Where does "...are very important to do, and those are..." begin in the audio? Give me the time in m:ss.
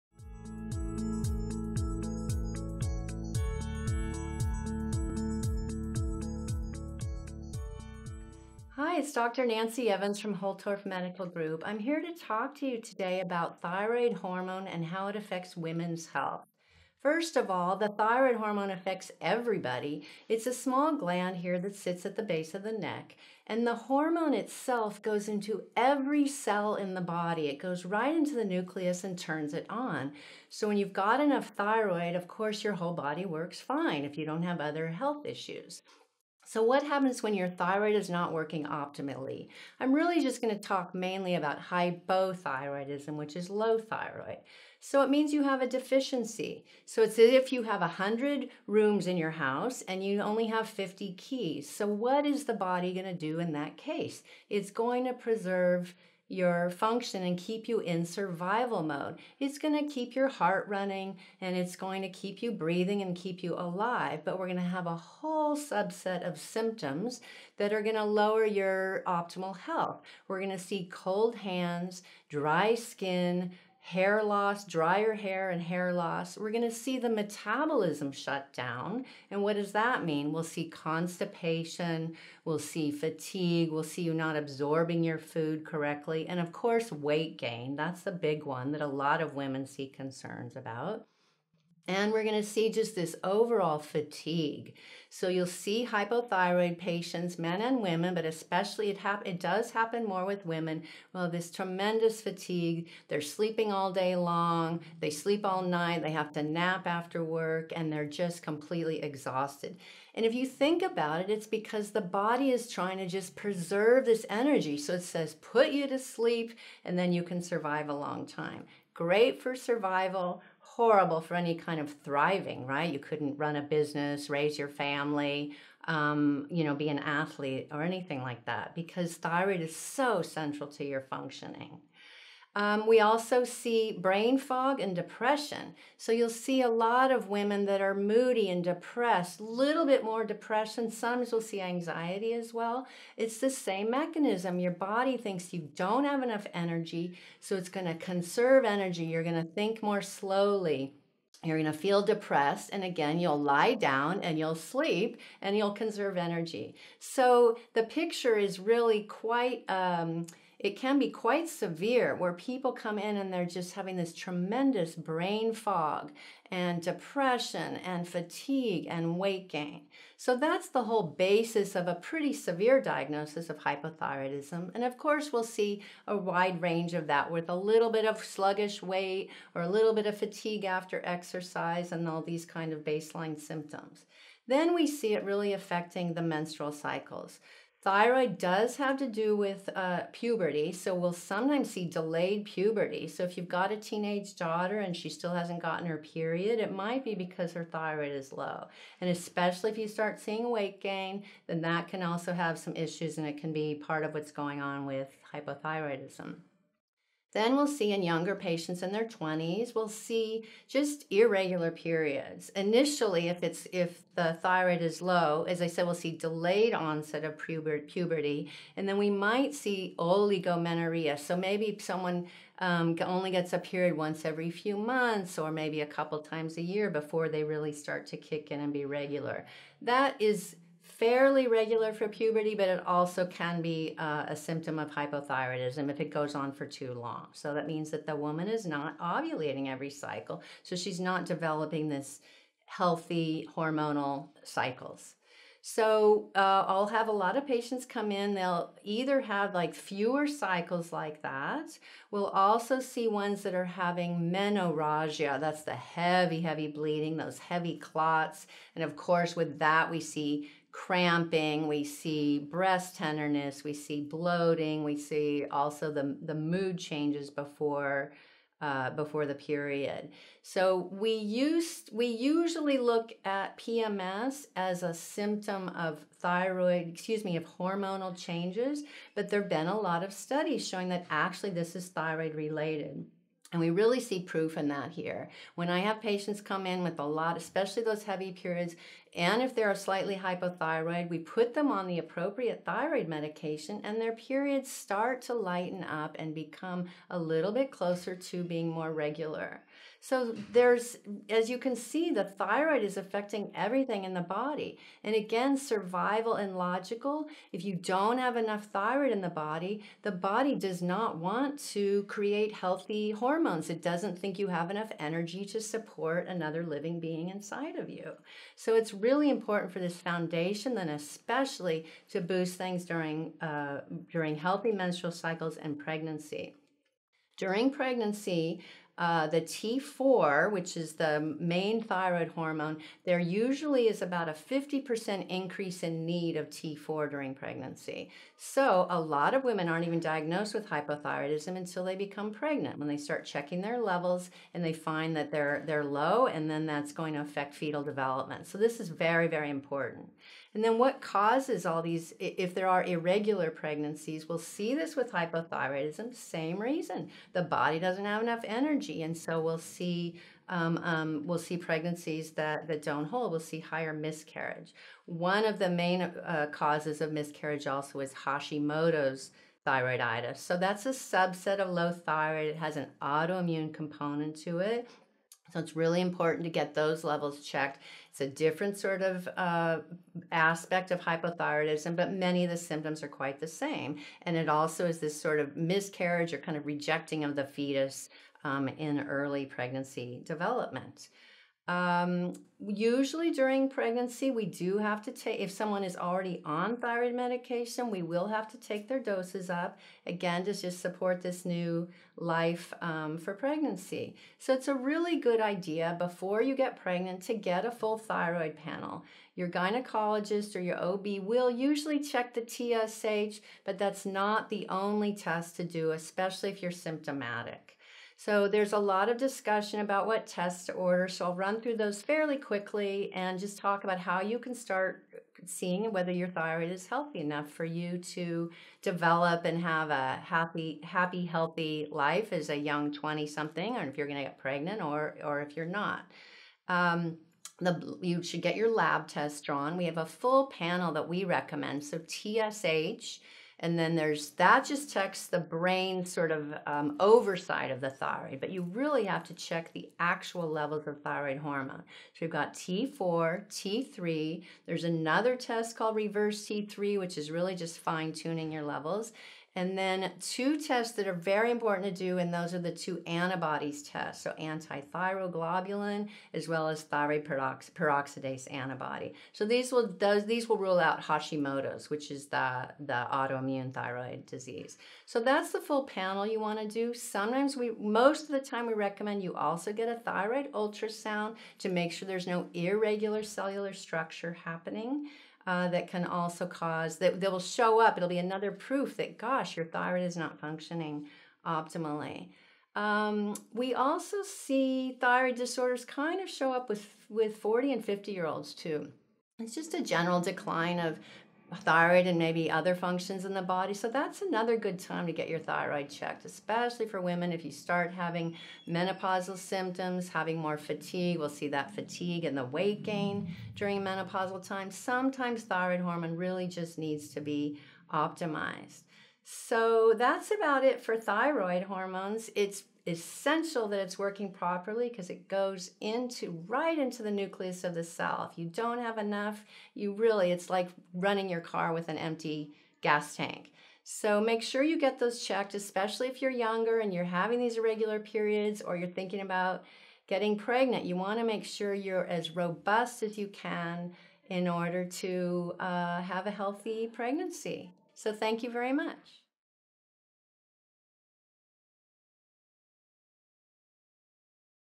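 7:41.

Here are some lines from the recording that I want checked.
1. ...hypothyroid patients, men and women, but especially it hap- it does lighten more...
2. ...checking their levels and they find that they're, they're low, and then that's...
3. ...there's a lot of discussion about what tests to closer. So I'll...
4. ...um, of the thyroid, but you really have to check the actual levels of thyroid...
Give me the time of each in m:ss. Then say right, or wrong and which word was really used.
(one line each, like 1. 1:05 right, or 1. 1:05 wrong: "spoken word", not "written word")
1. 1:35 wrong: "happen", not "lighten"
2. 5:43 right
3. 6:58 wrong: "order", not "closer"
4. 7:26 right.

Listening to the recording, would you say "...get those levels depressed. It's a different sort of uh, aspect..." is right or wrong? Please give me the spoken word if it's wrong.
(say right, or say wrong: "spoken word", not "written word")
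wrong: "checked", not "depressed".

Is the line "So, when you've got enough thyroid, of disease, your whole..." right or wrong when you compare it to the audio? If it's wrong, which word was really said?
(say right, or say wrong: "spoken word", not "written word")
wrong: "course", not "disease".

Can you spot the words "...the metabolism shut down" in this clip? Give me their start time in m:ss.
1:16.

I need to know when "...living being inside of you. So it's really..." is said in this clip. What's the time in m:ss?
5:16.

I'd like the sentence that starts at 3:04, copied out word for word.
Then we see it really affecting the menstrual cycles.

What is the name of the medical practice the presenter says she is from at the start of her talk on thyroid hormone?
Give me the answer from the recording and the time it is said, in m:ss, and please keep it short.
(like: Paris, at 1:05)
Holtorf Medical Group, at 0:10.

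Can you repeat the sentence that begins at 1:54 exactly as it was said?
So it says put you to sleep, and then you can survive a long time.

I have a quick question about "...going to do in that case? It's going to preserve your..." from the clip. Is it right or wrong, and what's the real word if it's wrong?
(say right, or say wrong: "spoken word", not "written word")
right.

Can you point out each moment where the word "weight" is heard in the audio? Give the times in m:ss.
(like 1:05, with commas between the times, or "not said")
1:26, 2:49, 2:58, 3:20, 8:32.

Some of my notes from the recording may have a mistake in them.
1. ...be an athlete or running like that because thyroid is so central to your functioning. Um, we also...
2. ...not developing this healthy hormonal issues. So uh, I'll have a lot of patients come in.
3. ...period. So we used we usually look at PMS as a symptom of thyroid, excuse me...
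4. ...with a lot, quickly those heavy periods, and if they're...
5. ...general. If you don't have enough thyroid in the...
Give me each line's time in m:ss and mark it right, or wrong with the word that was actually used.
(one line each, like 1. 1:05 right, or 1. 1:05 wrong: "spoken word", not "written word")
1. 2:06 wrong: "anything", not "running"
2. 4:00 wrong: "cycles", not "issues"
3. 4:29 right
4. 4:46 wrong: "especially", not "quickly"
5. 5:06 wrong: "logical", not "general".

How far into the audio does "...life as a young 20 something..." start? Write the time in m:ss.
7:11.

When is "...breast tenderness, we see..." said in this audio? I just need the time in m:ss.
4:22.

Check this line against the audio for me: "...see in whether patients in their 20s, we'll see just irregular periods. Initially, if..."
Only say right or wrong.
wrong.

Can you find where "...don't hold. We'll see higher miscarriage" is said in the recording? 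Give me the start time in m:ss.
6:02.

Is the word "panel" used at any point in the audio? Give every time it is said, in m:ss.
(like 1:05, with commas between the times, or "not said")
6:48, 7:20, 7:55.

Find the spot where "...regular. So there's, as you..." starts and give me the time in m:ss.
4:58.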